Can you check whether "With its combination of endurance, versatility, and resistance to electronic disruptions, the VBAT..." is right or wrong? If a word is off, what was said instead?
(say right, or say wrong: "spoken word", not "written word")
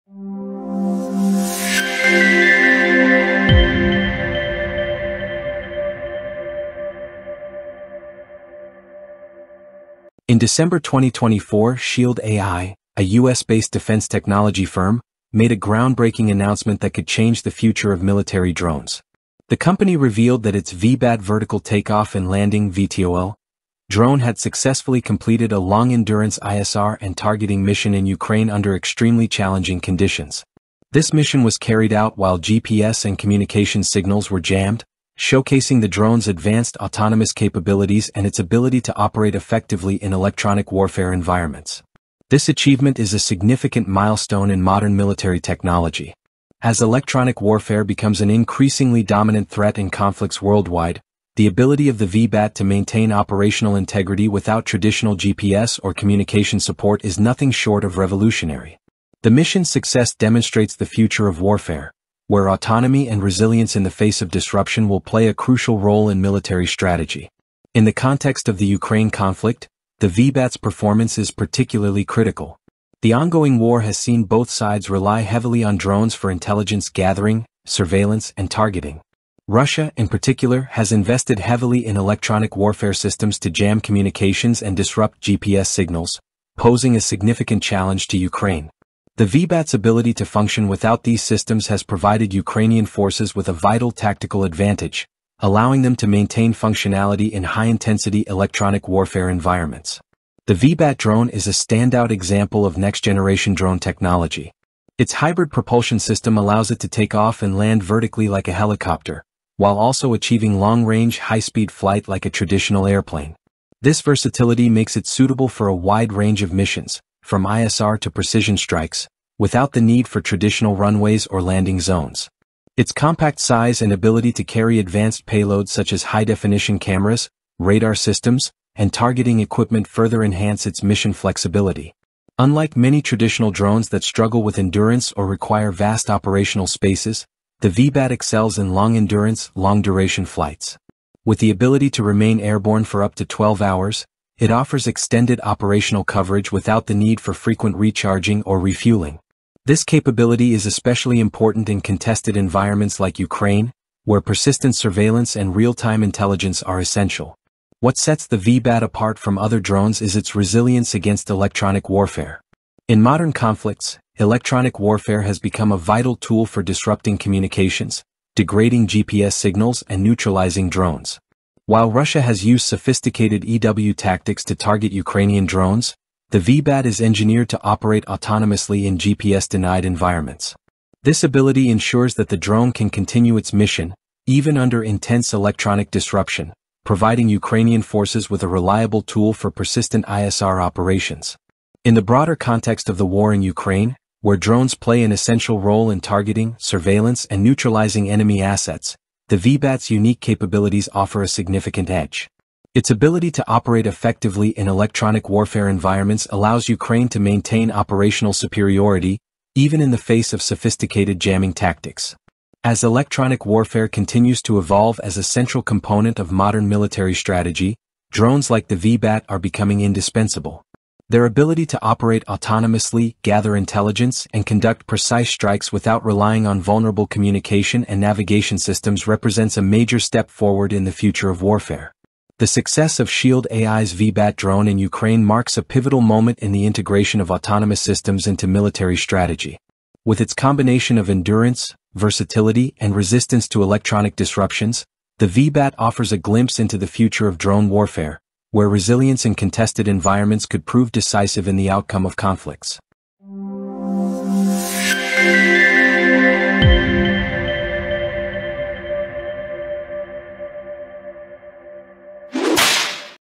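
right.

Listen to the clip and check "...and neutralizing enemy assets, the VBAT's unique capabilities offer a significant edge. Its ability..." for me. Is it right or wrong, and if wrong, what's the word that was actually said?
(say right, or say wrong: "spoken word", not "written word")
right.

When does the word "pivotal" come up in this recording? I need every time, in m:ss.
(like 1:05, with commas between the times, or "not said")
3:55.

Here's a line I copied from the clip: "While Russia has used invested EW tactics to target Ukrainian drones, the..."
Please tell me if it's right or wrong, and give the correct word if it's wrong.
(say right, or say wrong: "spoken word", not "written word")
wrong: "sophisticated", not "invested".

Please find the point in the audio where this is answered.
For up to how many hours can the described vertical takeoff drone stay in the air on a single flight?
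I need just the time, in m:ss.
2:23.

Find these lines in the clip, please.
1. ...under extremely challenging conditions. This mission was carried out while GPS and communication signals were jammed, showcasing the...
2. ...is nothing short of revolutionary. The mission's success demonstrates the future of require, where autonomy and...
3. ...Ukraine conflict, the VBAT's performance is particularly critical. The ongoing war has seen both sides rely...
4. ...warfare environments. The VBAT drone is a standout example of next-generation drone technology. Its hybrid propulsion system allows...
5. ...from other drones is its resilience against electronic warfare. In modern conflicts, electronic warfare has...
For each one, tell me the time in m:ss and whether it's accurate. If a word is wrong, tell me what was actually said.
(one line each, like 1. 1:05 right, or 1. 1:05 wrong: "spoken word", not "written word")
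1. 0:28 right
2. 0:57 wrong: "warfare", not "require"
3. 1:08 right
4. 1:38 right
5. 2:39 right.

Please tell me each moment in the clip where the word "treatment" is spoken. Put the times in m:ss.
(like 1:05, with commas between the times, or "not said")
not said.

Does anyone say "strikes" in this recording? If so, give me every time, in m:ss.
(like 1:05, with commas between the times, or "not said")
1:58, 3:45.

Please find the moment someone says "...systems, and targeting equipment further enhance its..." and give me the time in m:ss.
2:07.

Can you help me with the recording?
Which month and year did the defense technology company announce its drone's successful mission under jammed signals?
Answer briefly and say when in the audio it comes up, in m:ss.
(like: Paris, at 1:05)
December 2024, at 0:10.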